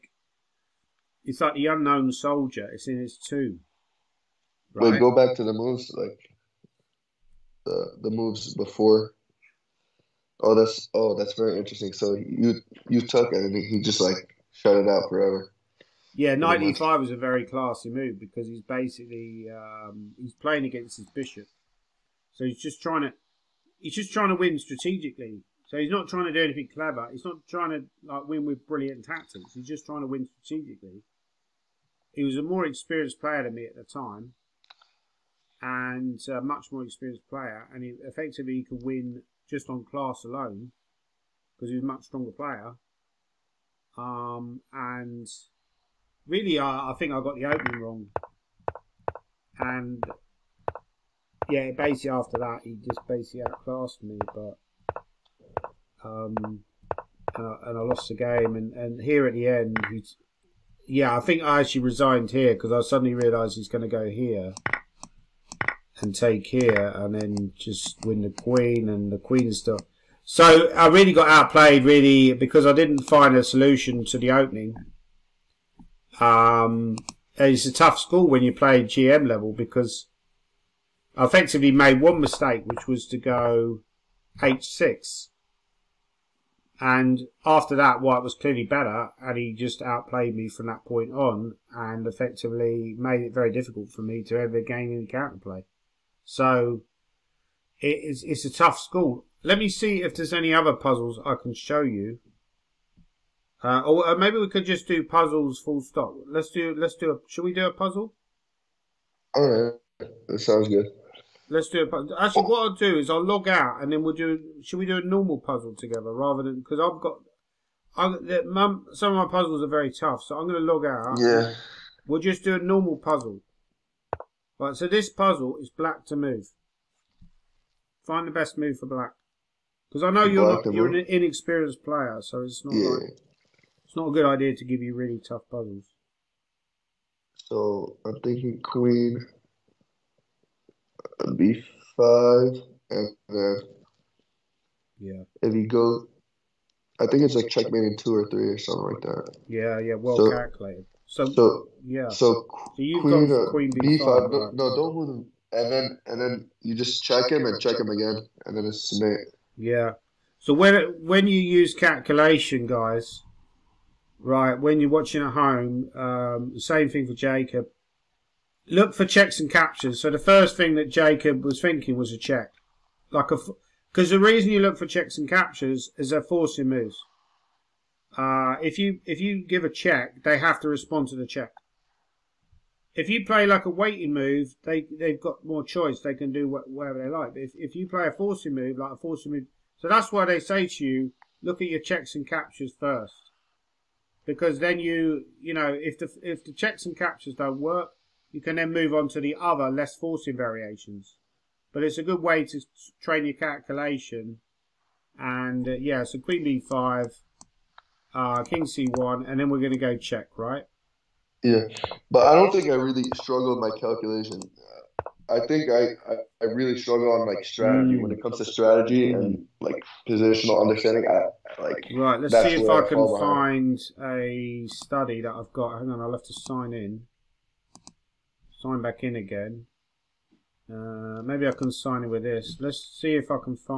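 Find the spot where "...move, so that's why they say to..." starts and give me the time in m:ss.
3:09.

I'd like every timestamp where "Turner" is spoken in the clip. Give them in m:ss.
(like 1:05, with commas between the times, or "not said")
not said.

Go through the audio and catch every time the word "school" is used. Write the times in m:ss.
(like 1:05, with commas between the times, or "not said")
1:17, 1:38.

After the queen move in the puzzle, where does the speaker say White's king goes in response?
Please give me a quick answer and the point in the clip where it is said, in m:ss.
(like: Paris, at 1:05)
c1, at 3:28.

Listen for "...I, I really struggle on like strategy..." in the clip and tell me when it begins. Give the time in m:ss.
3:36.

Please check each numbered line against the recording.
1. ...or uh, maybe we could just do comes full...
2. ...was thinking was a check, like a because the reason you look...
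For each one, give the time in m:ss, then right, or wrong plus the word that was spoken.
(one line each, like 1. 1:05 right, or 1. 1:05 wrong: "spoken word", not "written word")
1. 1:43 wrong: "puzzles", not "comes"
2. 2:51 right.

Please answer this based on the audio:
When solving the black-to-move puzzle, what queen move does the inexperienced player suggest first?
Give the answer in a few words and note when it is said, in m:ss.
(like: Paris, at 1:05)
Queen b5, at 2:18.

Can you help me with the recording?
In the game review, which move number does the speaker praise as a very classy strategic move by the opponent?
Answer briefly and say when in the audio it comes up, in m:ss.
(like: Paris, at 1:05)
95, at 0:16.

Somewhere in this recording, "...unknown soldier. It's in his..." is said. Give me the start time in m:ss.
0:01.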